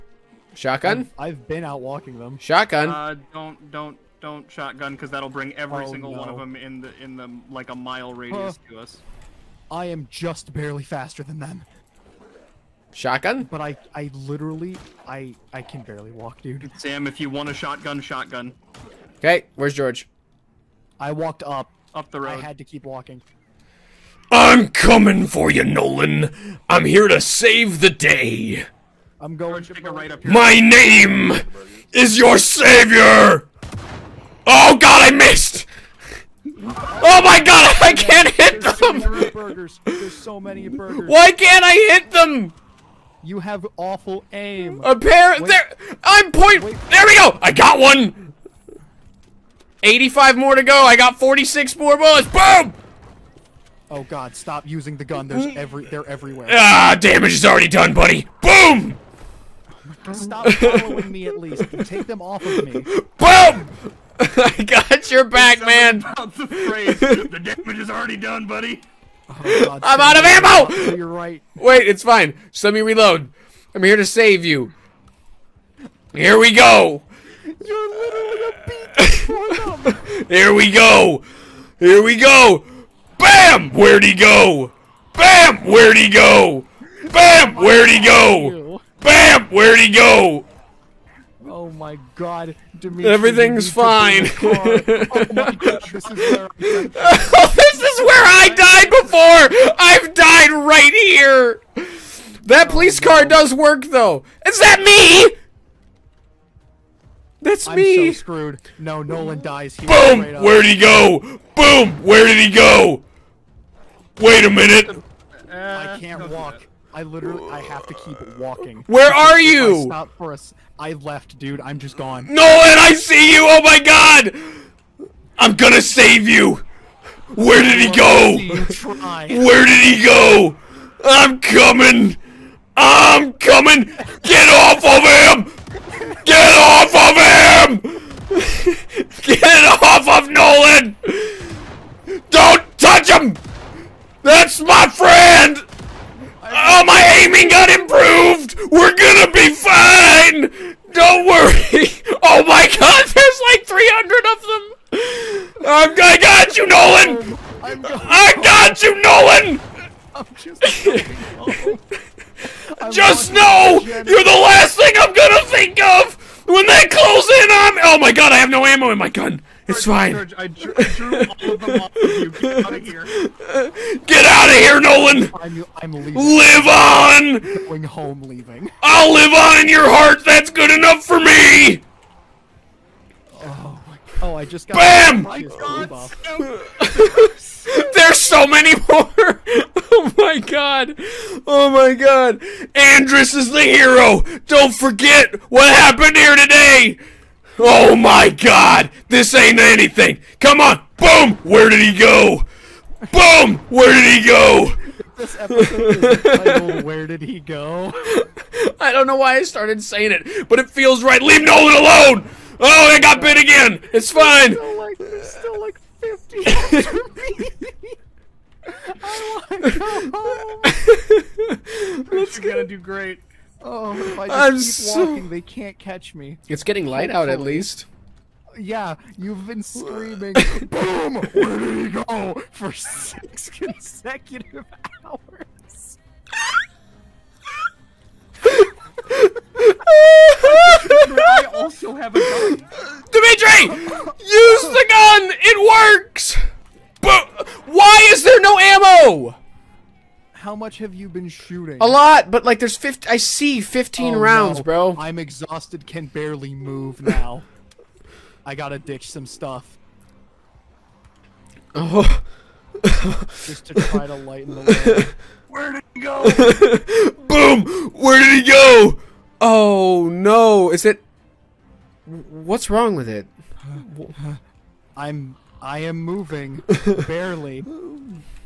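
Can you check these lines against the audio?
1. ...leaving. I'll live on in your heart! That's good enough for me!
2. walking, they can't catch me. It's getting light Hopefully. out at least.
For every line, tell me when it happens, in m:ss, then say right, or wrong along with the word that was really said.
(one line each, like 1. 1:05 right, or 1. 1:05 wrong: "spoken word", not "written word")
1. 2:58 right
2. 3:45 right.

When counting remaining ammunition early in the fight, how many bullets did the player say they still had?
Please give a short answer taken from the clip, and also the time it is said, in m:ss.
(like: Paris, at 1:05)
46, at 0:51.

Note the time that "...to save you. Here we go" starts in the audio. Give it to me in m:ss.
1:13.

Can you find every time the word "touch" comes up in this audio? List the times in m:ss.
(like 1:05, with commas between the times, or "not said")
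2:22.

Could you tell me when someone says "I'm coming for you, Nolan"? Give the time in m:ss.
0:24.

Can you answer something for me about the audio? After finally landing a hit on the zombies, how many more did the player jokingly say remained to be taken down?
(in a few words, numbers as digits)
85.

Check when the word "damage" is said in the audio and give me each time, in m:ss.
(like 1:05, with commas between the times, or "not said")
0:56, 1:07.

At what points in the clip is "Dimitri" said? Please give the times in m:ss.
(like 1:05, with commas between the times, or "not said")
1:32, 4:03.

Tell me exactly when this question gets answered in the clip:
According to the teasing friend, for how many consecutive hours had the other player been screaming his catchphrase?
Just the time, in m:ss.
3:52.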